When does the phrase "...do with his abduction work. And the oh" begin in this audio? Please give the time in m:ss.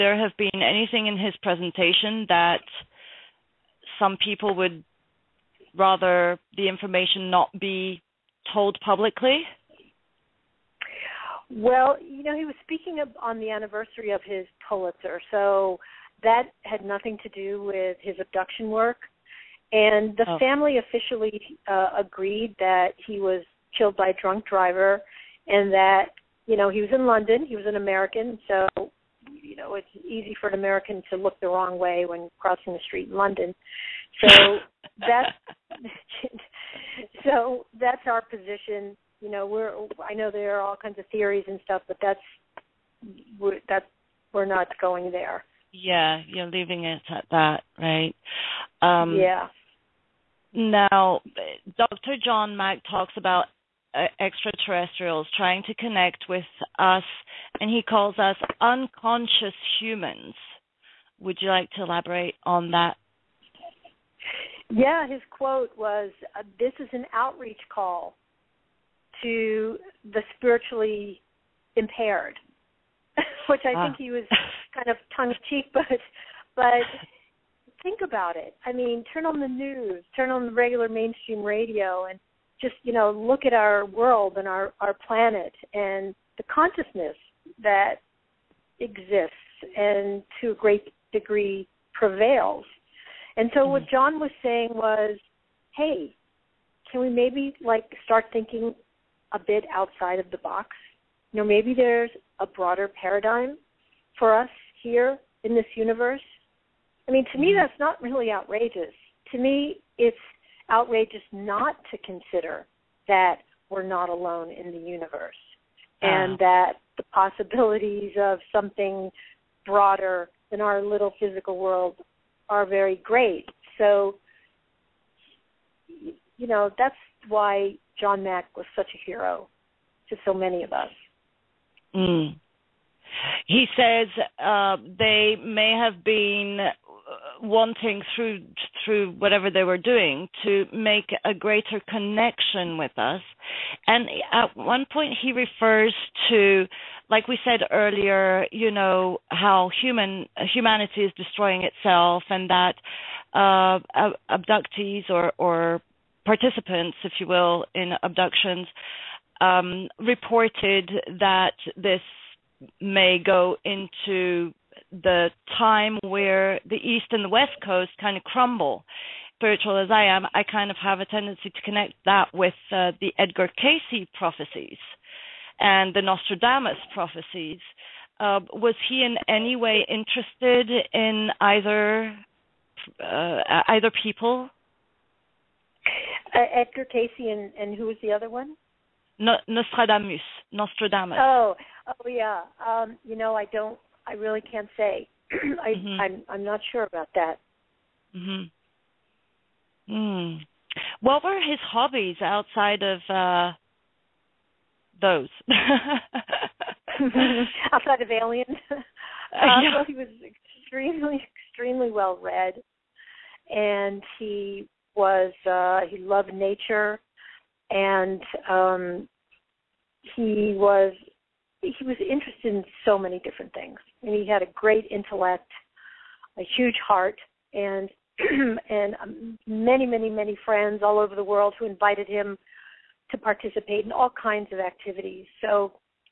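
0:17.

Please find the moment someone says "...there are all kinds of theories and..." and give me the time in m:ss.
0:40.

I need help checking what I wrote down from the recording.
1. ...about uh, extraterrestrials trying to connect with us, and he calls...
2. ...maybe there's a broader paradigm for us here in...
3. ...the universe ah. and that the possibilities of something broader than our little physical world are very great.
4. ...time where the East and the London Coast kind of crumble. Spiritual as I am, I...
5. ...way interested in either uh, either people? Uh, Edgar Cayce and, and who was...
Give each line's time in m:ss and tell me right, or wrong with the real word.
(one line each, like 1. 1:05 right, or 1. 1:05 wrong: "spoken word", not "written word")
1. 0:53 right
2. 1:41 right
3. 1:54 right
4. 2:45 wrong: "West", not "London"
5. 2:59 right.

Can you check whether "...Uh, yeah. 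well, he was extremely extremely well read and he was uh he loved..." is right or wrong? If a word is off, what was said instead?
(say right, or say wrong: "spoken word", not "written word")
right.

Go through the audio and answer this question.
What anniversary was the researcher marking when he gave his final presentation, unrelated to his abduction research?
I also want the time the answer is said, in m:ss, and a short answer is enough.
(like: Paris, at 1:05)
his Pulitzer, at 0:14.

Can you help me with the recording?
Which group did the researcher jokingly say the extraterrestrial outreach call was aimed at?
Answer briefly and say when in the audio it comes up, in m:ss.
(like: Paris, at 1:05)
the spiritually impaired, at 1:10.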